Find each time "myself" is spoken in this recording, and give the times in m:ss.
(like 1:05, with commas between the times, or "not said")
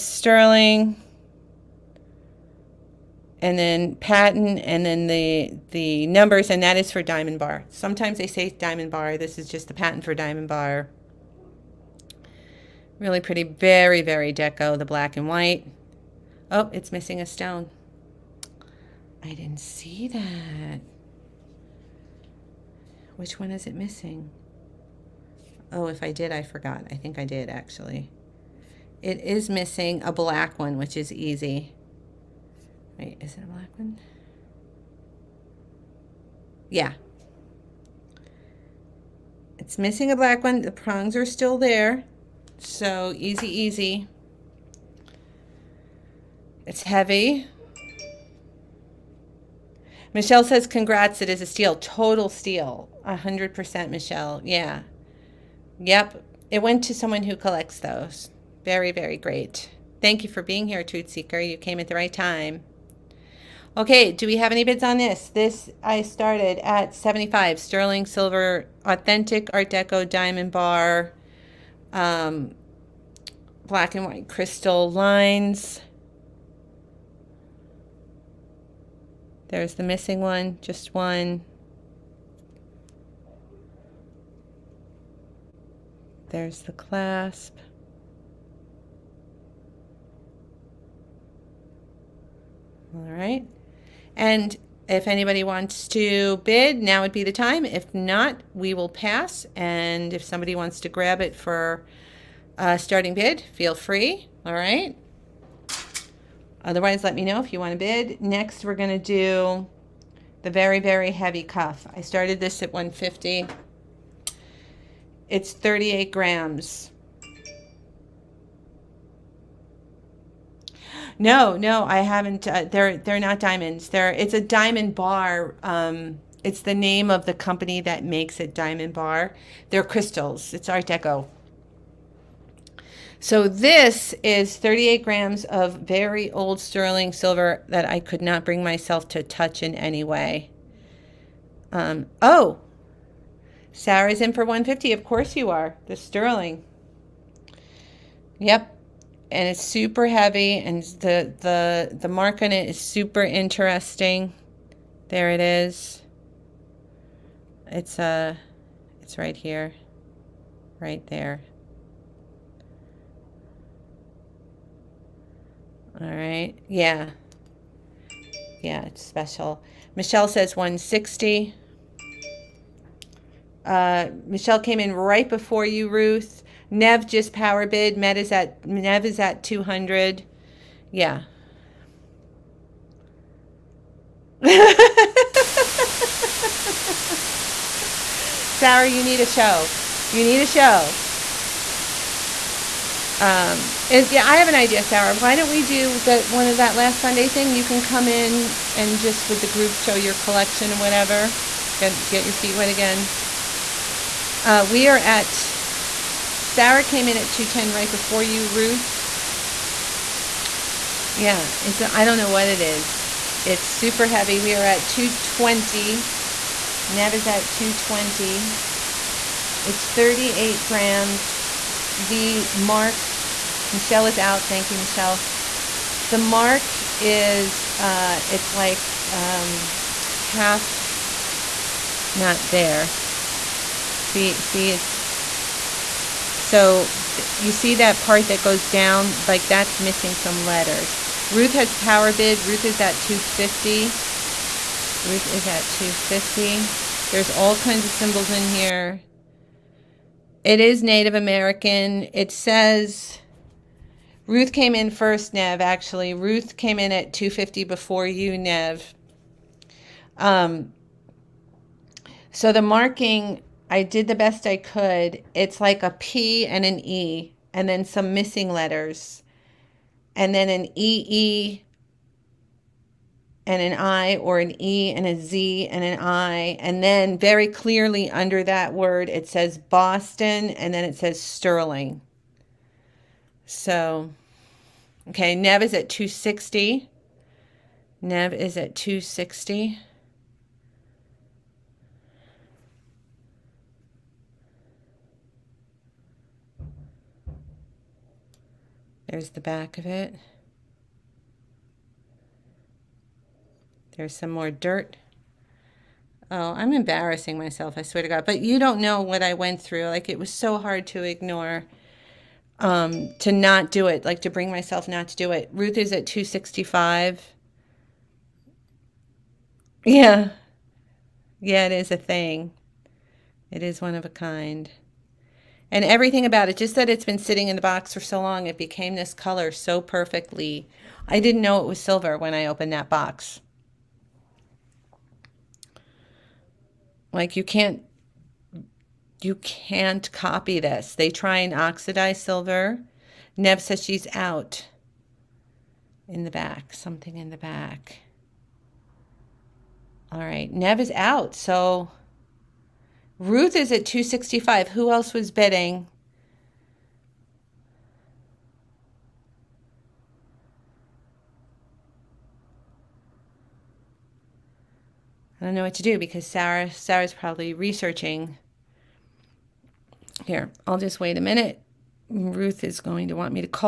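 2:18, 5:07, 5:14.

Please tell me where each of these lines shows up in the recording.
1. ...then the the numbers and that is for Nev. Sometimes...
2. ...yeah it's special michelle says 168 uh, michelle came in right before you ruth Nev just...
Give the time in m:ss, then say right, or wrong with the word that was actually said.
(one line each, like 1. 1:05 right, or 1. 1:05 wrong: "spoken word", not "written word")
1. 0:04 wrong: "Diamonbar", not "Nev"
2. 2:48 wrong: "160", not "168".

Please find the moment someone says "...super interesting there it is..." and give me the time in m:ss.
2:32.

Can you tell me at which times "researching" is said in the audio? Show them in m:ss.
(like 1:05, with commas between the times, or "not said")
6:07.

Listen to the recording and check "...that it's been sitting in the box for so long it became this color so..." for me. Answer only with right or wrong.
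right.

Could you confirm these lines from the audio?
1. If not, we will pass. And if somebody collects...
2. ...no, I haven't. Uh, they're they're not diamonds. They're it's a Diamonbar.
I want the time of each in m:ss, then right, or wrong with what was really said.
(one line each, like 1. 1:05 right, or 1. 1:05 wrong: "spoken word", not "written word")
1. 1:37 wrong: "wants", not "collects"
2. 2:01 right.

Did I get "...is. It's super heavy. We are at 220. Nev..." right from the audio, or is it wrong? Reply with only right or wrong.
right.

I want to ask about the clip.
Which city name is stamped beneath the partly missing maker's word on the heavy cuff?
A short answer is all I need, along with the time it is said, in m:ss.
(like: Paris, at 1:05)
Boston, at 4:39.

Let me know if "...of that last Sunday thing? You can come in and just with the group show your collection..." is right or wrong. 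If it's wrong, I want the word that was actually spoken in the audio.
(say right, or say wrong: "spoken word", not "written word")
right.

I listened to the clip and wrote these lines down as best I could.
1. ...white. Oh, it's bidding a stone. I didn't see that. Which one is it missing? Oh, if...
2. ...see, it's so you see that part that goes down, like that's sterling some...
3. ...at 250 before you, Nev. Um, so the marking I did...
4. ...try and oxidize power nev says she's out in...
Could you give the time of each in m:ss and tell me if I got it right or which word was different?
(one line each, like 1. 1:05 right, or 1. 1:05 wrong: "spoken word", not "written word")
1. 0:15 wrong: "missing", not "bidding"
2. 3:54 wrong: "missing", not "sterling"
3. 4:16 right
4. 5:41 wrong: "silver", not "power".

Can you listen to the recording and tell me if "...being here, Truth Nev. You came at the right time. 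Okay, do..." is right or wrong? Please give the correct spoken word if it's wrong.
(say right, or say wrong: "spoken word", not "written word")
wrong: "Seeker", not "Nev".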